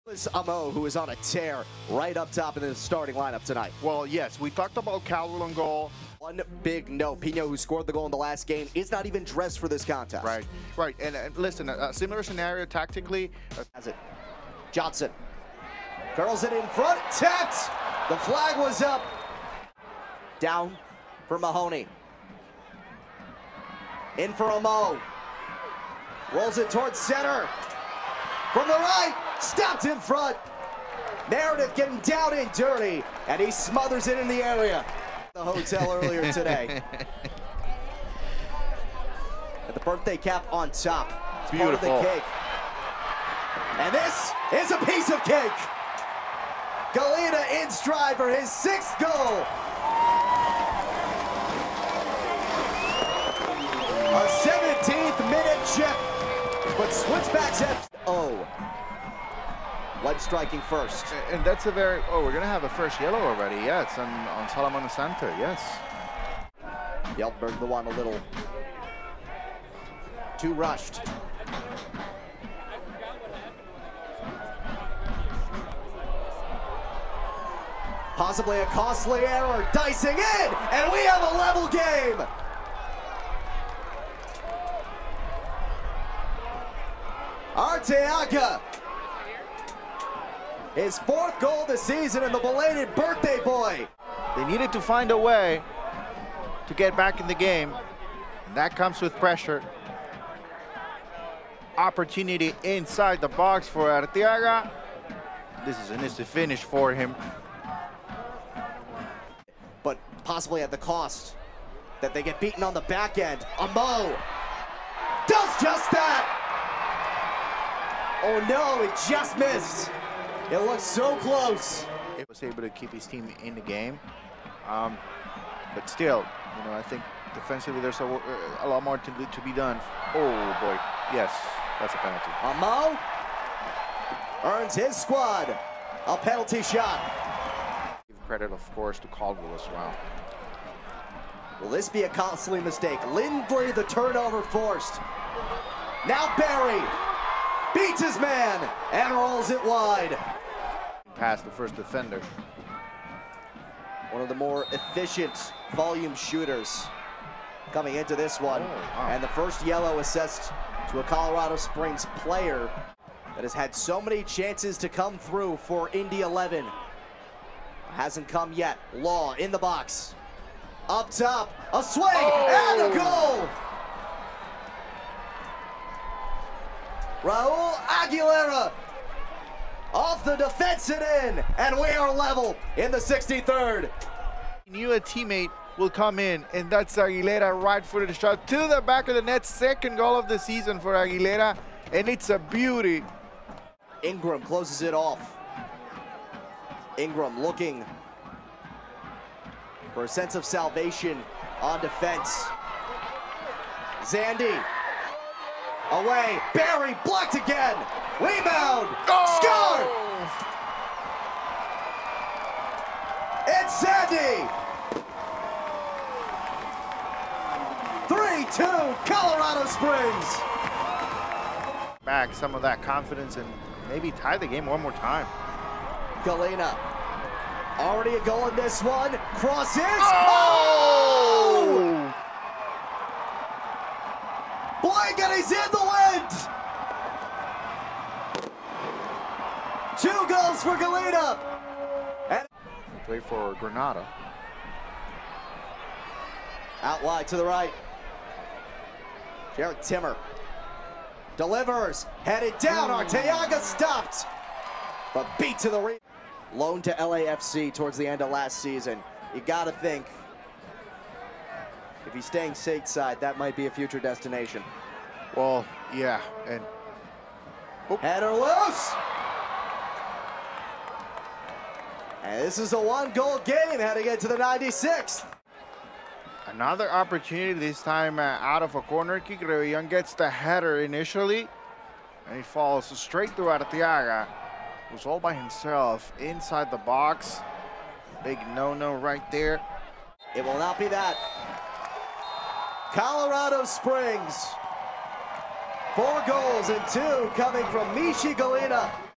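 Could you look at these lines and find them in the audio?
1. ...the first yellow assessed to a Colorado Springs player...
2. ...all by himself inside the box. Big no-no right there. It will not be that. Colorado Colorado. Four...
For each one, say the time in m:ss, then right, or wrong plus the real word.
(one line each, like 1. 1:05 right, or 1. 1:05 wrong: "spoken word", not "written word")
1. 2:39 right
2. 4:45 wrong: "Springs", not "Colorado".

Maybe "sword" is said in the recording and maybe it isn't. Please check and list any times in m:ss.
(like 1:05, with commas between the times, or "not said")
not said.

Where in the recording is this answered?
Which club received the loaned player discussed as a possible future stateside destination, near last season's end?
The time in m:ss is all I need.
4:16.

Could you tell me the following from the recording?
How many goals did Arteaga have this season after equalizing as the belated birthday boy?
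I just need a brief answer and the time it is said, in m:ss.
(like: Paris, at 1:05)
4, at 1:30.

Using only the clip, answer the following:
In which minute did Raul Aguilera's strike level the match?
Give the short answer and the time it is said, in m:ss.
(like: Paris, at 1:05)
63rd, at 3:02.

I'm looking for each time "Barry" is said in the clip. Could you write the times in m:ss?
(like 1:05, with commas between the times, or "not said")
2:26, 3:26.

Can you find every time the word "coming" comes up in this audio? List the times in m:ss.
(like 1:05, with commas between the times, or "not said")
2:37, 4:57.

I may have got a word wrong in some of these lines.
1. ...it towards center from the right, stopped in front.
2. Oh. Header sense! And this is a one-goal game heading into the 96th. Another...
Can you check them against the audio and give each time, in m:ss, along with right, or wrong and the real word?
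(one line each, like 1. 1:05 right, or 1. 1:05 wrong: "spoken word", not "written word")
1. 0:26 right
2. 4:27 wrong: "loose", not "sense".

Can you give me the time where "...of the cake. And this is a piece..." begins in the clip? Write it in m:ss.
0:42.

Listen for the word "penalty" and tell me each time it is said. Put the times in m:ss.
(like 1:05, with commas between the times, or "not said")
2:11, 2:16.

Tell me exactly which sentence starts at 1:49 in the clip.
But possibly at the cost that they get beaten on the back end.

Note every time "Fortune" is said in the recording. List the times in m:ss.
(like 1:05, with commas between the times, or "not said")
not said.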